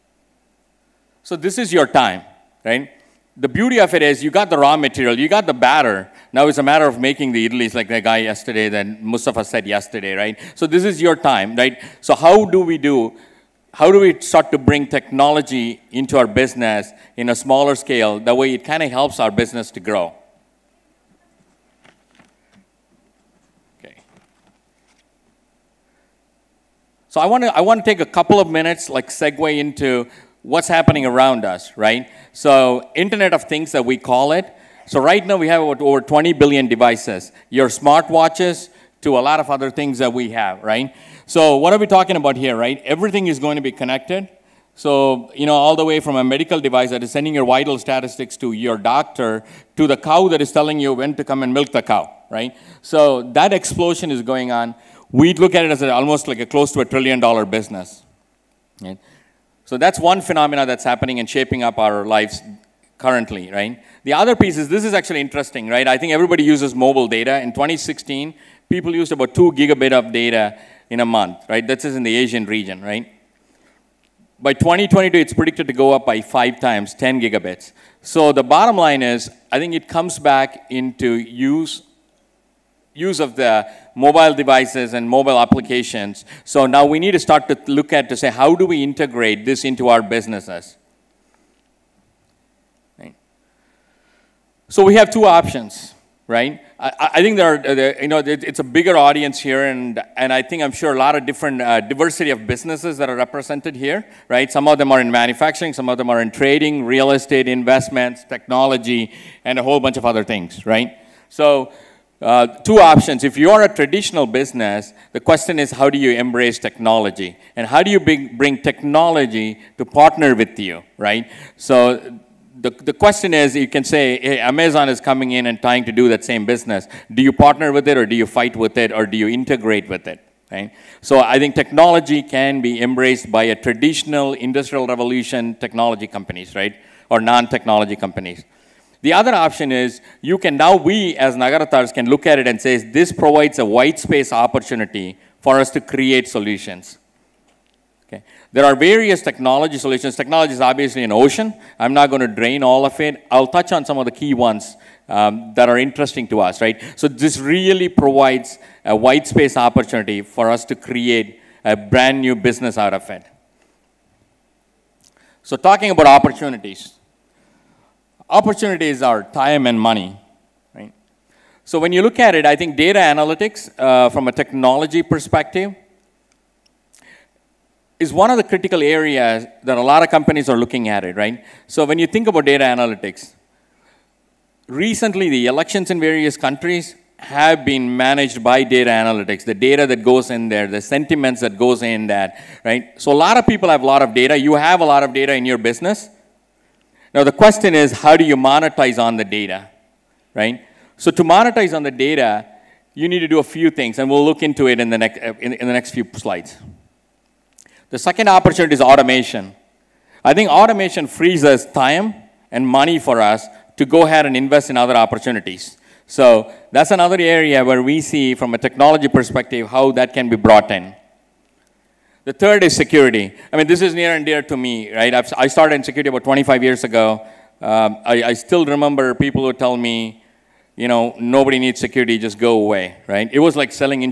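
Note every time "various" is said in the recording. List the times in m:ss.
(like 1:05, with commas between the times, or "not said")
2:28, 3:05.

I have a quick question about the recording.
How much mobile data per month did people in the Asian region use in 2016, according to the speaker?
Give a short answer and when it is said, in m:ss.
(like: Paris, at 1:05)
2 gigabit, at 1:09.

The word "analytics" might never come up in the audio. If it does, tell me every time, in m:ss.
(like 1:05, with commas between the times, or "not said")
2:52, 3:02, 3:08.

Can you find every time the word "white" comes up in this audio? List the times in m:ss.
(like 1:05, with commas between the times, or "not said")
2:23, 2:38.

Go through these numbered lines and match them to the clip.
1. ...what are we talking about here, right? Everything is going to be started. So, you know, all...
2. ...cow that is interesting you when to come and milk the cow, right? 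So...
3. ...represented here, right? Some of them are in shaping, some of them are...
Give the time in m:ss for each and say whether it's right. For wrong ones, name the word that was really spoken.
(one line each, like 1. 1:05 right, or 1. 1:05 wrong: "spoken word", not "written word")
1. 0:41 wrong: "connected", not "started"
2. 0:49 wrong: "telling", not "interesting"
3. 1:43 wrong: "manufacturing", not "shaping".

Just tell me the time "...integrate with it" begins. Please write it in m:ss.
2:09.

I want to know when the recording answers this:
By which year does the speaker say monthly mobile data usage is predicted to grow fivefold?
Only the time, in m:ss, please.
1:14.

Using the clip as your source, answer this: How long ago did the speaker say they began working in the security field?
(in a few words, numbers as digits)
25 years ago.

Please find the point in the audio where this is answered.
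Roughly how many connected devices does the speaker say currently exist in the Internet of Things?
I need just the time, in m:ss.
0:35.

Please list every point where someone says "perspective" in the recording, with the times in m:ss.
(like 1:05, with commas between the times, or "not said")
2:55, 3:39.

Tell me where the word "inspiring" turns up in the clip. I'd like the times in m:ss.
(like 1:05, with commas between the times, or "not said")
not said.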